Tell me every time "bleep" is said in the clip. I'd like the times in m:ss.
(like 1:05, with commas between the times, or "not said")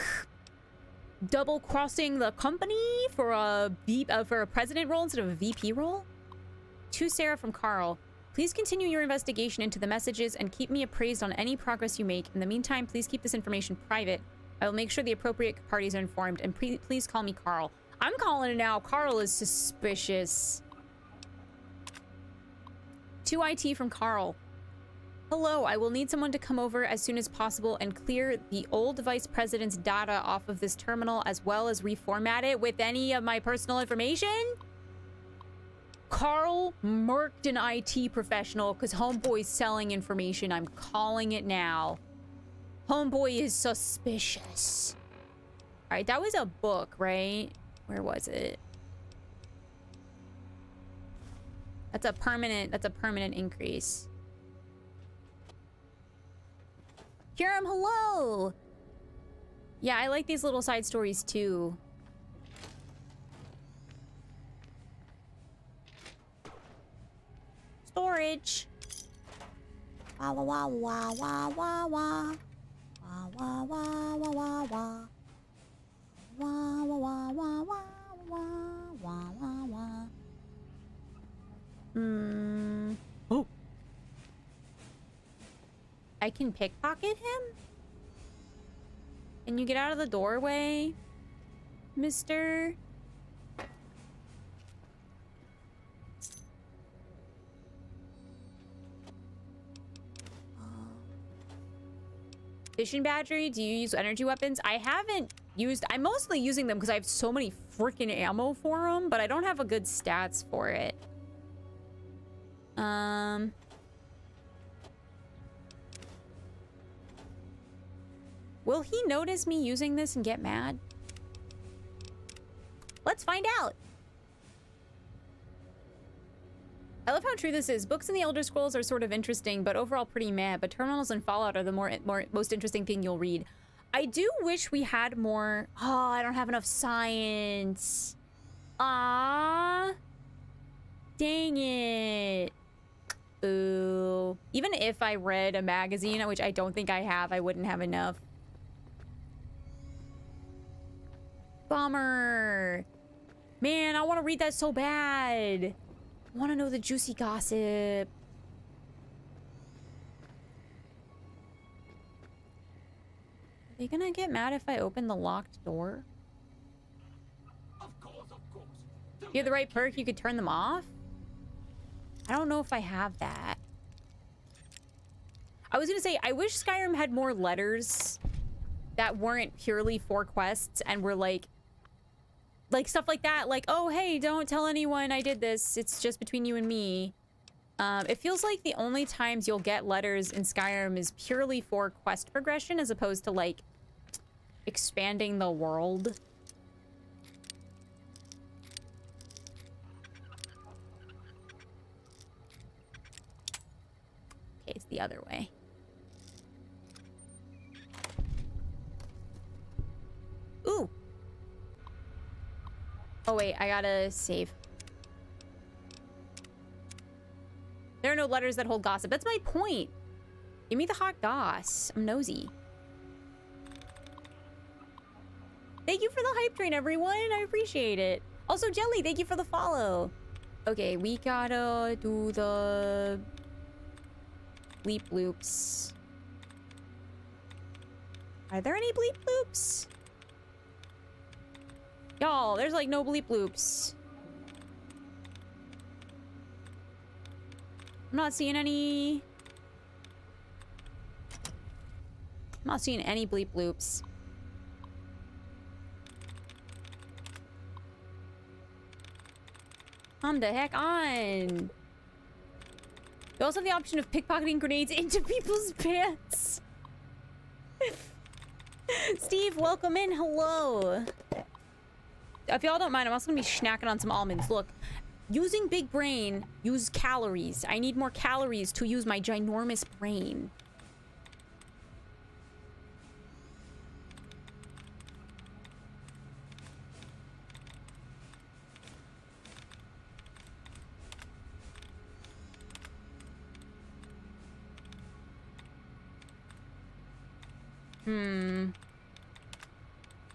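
3:54, 3:58, 4:03, 4:13.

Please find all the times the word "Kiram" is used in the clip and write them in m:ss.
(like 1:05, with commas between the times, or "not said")
0:57.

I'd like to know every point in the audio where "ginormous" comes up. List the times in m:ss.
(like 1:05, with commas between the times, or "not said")
4:39.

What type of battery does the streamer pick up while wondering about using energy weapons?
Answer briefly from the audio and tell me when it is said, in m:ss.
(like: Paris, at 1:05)
Fission battery, at 1:42.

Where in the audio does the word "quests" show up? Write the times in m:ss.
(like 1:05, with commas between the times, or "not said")
3:00, 3:11.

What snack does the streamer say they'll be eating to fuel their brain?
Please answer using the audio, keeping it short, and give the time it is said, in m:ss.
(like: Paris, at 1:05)
Almonds, at 4:34.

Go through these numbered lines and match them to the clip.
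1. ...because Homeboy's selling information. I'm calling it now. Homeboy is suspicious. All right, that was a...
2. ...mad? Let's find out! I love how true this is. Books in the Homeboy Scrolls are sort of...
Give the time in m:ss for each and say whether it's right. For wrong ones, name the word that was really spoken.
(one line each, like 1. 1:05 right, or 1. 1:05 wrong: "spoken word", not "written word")
1. 0:38 right
2. 2:00 wrong: "Elder", not "Homeboy".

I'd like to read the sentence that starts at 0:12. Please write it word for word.
In the meantime, please keep this information private.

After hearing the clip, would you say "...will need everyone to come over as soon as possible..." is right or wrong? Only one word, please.
wrong.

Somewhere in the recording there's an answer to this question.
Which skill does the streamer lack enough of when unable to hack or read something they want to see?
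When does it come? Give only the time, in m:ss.
2:16.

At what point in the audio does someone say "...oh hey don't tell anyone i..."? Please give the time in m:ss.
3:03.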